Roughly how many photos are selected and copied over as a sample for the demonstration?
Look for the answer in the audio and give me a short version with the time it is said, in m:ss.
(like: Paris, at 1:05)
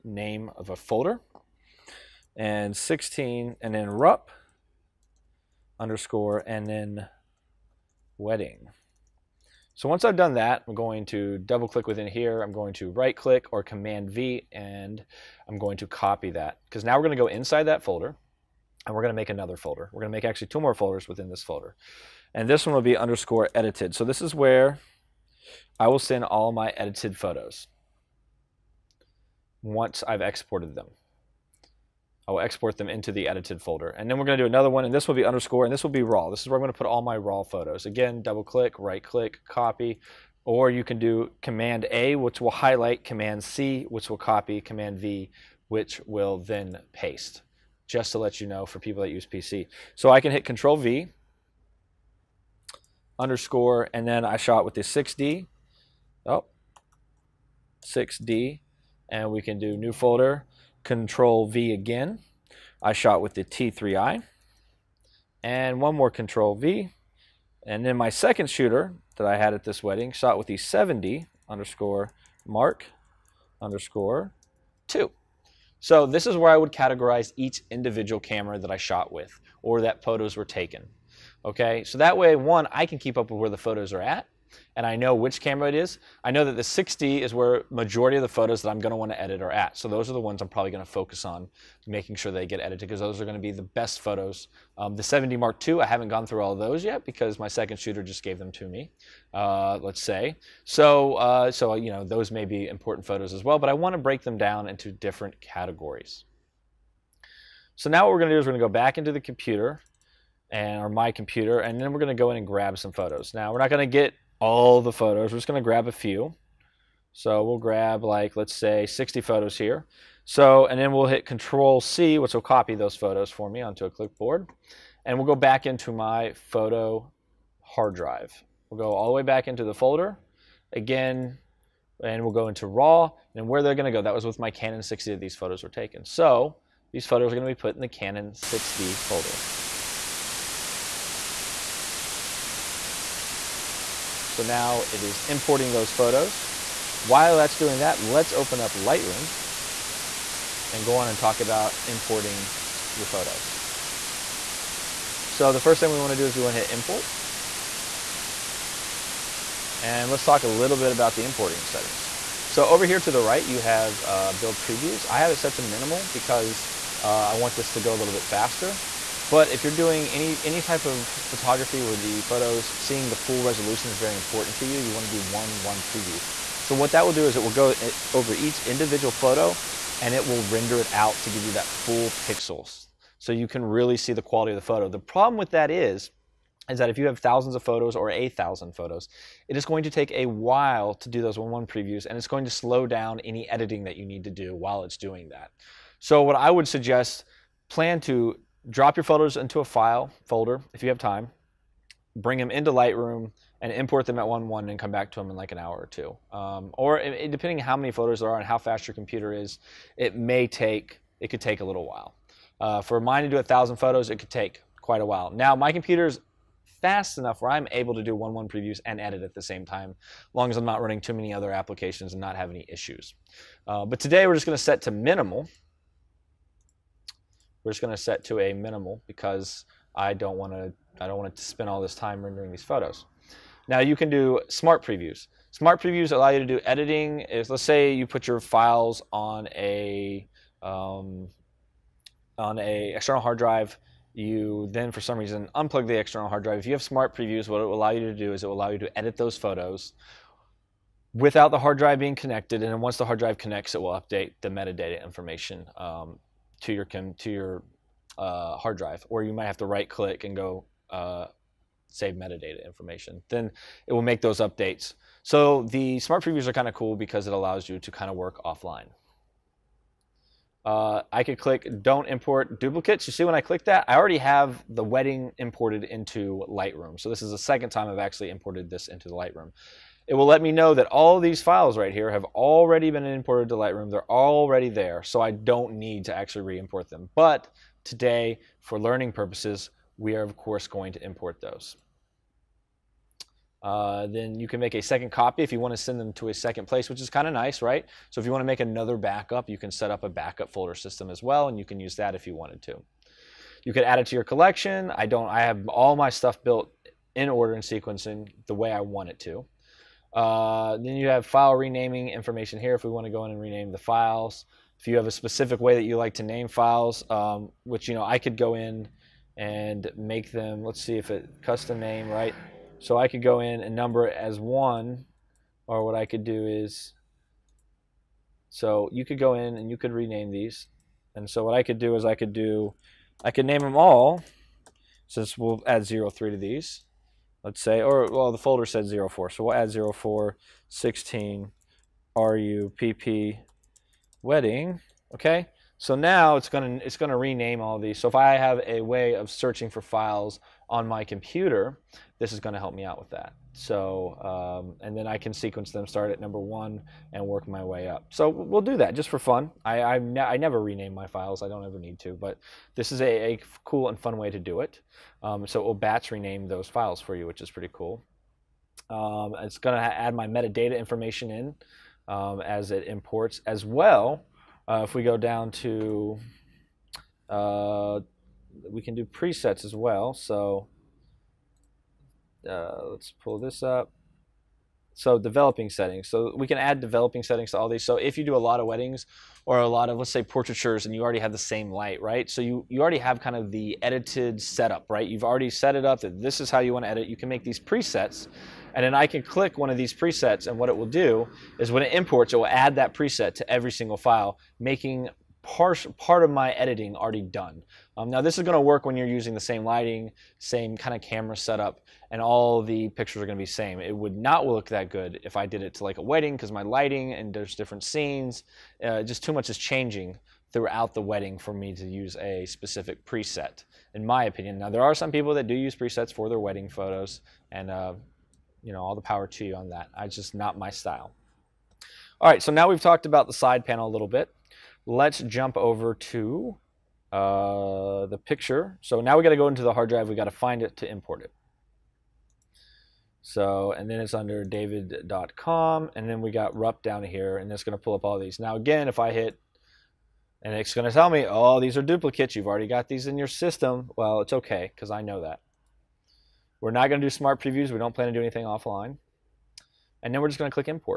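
60, at 1:58.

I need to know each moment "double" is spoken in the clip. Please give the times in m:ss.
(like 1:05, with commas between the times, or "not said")
0:11, 0:38.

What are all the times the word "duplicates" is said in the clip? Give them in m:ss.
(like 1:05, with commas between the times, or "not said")
4:32, 7:31.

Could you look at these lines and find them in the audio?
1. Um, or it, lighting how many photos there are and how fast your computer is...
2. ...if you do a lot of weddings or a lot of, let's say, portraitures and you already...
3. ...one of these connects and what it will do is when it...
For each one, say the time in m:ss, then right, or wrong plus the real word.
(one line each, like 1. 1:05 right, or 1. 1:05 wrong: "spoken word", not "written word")
1. 3:26 wrong: "depending", not "lighting"
2. 6:27 right
3. 6:39 wrong: "presets", not "connects".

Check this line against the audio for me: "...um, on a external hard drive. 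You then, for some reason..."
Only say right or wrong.
right.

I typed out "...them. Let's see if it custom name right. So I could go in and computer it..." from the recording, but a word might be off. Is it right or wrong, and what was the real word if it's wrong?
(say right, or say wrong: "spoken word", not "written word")
wrong: "number", not "computer".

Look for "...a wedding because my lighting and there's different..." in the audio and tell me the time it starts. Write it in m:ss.
6:55.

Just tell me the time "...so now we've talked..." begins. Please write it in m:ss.
7:12.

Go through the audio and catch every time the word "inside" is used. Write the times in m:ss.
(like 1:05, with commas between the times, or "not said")
0:17.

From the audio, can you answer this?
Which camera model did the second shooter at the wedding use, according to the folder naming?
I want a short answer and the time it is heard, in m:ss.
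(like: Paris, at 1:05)
7D Mark II, at 1:10.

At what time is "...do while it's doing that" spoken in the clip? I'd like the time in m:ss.
3:14.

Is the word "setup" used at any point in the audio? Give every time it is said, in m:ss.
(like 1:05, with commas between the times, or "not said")
6:34, 6:51.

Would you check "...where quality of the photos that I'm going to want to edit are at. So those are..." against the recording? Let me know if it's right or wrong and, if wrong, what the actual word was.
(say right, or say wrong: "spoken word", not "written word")
wrong: "majority", not "quality".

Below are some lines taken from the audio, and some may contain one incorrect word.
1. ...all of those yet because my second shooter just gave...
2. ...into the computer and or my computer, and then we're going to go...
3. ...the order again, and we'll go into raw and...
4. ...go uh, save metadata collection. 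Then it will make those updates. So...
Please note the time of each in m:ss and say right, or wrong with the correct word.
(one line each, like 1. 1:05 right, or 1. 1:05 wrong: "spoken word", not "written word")
1. 1:36 right
2. 1:48 right
3. 2:09 wrong: "folder", not "order"
4. 4:20 wrong: "information", not "collection".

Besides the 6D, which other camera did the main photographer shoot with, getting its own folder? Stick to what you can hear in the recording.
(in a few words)
T3i.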